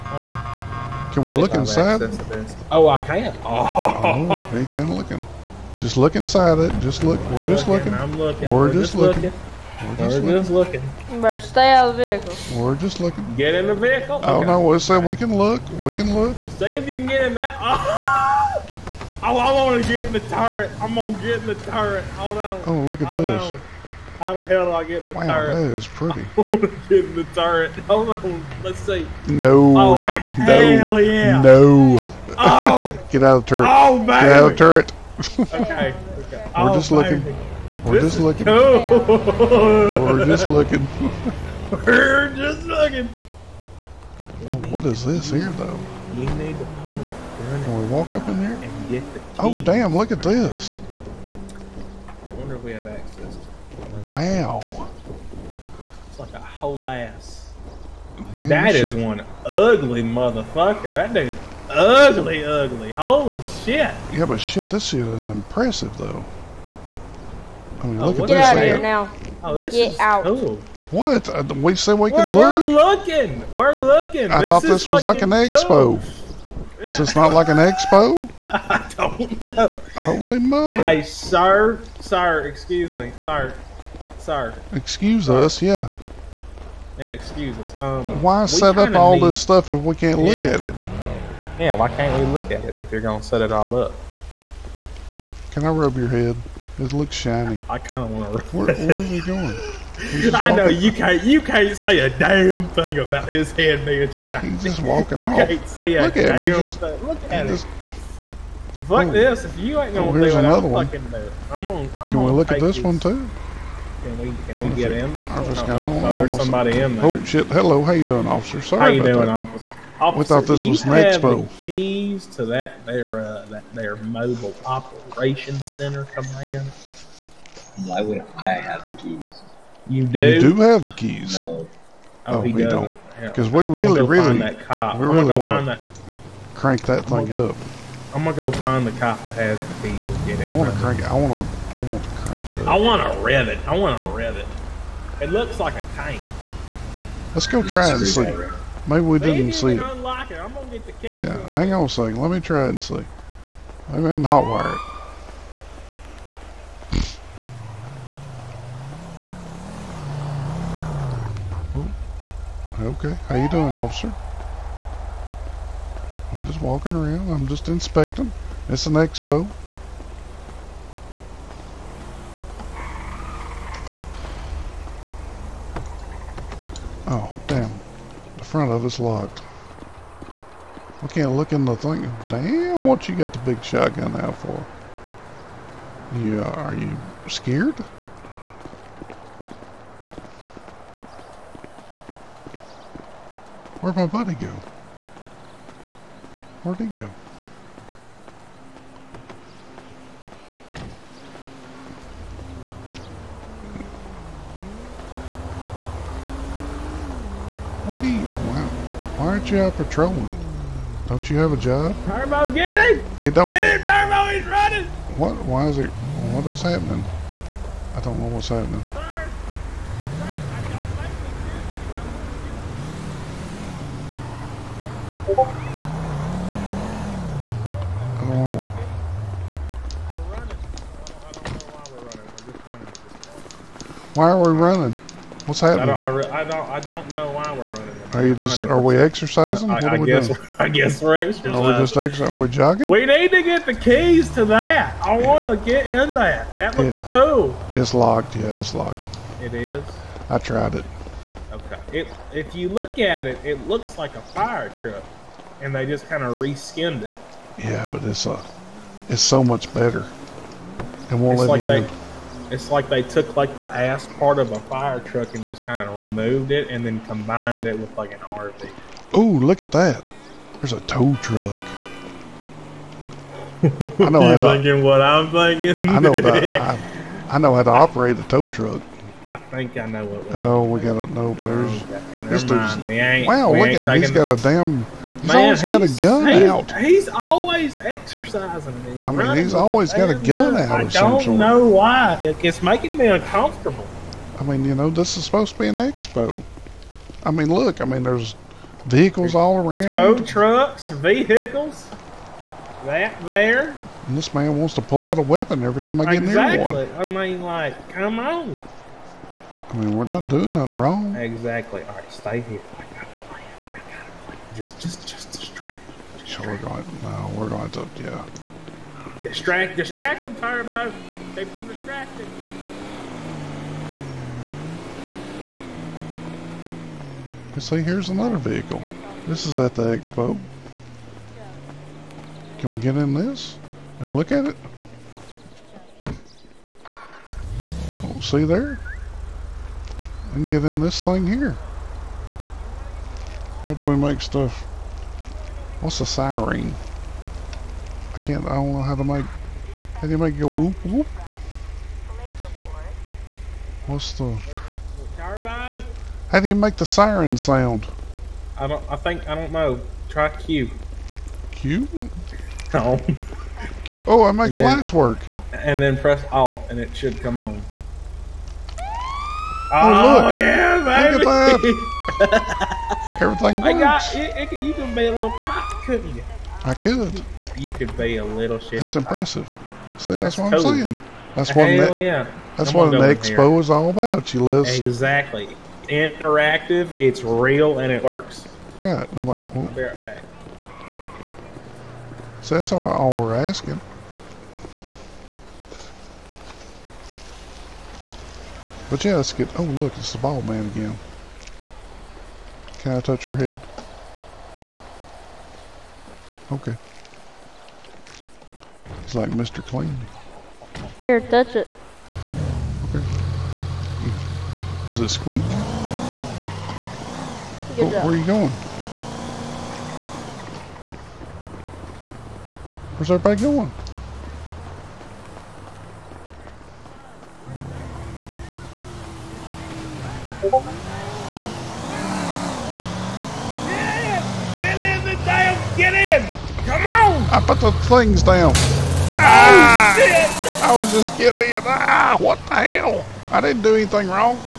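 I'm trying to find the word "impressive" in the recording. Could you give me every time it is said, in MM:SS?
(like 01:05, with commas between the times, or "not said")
01:05, 06:18.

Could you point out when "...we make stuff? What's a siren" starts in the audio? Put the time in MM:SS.
05:43.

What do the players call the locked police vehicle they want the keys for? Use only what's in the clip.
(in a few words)
operations center command.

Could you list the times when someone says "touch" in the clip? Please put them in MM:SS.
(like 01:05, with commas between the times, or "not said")
06:42, 06:51.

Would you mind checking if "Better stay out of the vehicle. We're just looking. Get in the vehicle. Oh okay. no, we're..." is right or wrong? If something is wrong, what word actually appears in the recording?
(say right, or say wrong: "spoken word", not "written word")
right.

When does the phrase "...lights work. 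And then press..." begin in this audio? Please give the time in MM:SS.
06:04.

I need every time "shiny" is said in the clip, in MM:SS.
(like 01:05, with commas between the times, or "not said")
01:37, 01:44.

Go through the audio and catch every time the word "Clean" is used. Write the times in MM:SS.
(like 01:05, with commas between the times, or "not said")
06:49.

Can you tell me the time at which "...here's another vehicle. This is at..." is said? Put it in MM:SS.
05:27.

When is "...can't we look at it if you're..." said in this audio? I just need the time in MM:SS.
01:31.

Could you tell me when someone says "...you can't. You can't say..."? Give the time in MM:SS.
01:40.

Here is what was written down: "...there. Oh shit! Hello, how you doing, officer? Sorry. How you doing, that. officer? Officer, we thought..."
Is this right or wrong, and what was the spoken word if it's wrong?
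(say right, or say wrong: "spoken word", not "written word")
right.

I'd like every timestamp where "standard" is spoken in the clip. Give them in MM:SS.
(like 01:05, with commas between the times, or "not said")
not said.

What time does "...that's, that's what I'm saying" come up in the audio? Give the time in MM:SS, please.
06:20.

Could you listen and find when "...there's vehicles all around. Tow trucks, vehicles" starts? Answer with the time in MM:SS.
04:58.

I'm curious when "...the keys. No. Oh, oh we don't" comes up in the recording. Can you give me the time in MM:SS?
02:10.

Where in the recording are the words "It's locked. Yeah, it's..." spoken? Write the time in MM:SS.
04:07.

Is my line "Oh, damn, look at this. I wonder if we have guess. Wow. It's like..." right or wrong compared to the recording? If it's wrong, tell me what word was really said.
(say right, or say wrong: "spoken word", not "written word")
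wrong: "access", not "guess".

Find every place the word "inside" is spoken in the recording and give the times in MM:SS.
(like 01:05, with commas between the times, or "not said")
00:01, 00:06.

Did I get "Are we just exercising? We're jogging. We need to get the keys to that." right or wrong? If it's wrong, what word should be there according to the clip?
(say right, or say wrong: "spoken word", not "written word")
right.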